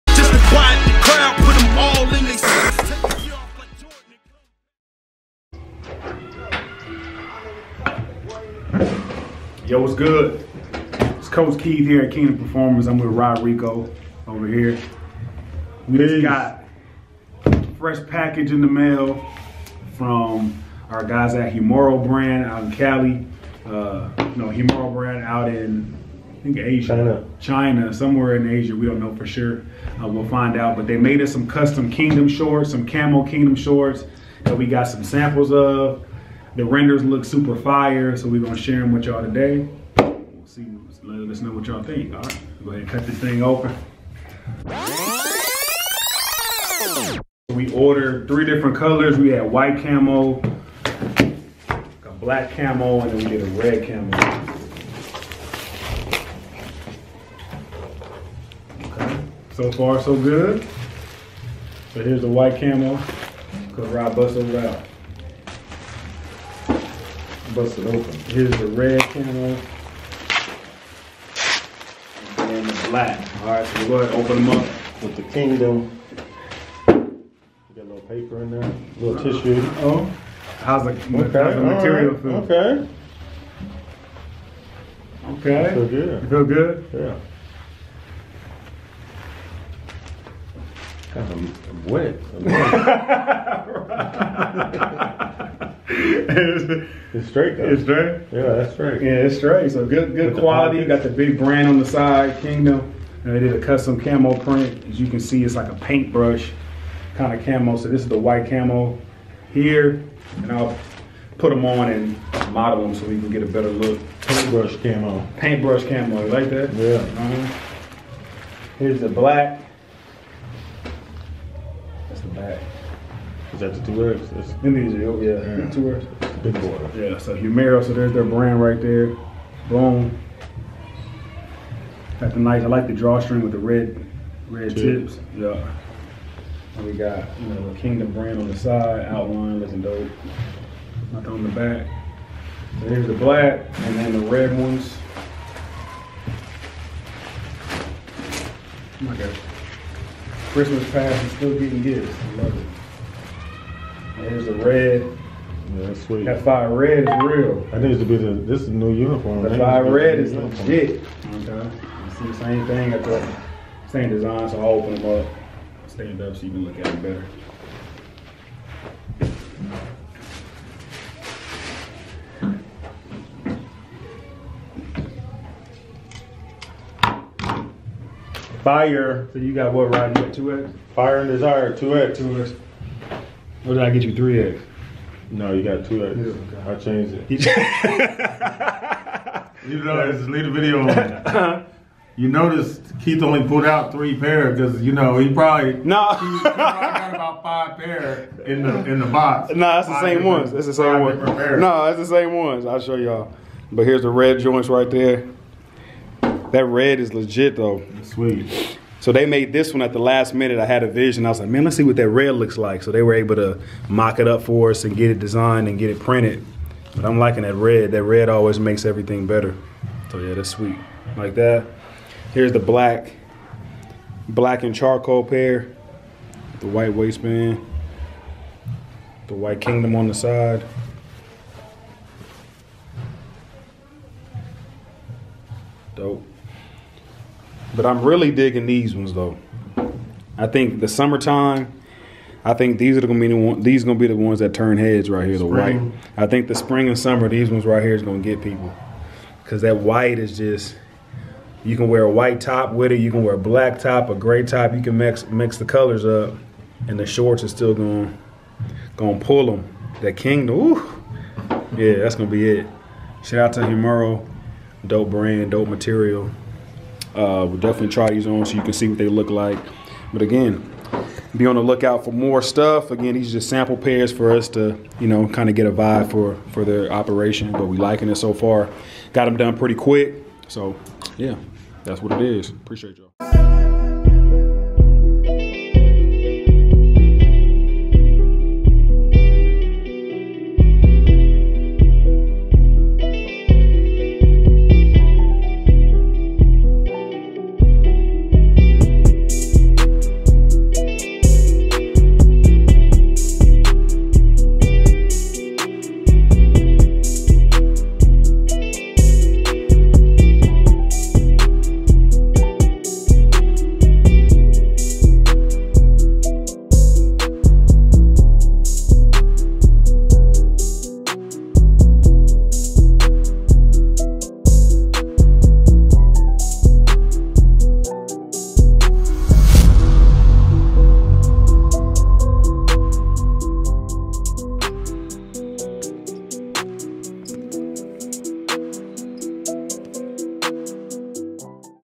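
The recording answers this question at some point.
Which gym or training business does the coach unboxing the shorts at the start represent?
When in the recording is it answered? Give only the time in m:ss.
0:12.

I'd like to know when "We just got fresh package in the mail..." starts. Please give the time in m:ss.
0:15.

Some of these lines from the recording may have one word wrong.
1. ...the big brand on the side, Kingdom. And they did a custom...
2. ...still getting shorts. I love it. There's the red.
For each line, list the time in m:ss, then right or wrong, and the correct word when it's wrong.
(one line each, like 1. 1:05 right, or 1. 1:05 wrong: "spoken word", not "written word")
1. 1:41 right
2. 2:31 wrong: "gifts", not "shorts".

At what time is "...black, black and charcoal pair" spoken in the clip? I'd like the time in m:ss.
3:42.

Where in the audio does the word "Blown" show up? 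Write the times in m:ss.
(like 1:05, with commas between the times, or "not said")
2:09.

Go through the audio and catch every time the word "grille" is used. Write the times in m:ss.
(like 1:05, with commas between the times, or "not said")
not said.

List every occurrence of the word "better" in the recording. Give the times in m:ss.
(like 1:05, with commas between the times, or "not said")
1:53, 2:47, 3:39.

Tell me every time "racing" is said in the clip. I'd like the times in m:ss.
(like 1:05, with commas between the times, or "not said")
not said.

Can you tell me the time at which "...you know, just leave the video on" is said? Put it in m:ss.
3:09.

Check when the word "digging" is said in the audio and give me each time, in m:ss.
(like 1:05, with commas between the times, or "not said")
3:58.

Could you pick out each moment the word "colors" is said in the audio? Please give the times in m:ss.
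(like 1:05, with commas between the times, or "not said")
0:48, 4:15.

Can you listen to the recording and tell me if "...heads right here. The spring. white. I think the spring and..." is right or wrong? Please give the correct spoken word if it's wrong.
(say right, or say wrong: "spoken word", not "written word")
right.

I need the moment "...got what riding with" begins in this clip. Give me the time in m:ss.
2:59.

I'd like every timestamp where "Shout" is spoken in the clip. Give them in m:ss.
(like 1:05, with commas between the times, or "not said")
4:23.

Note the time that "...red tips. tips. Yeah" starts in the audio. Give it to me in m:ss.
2:14.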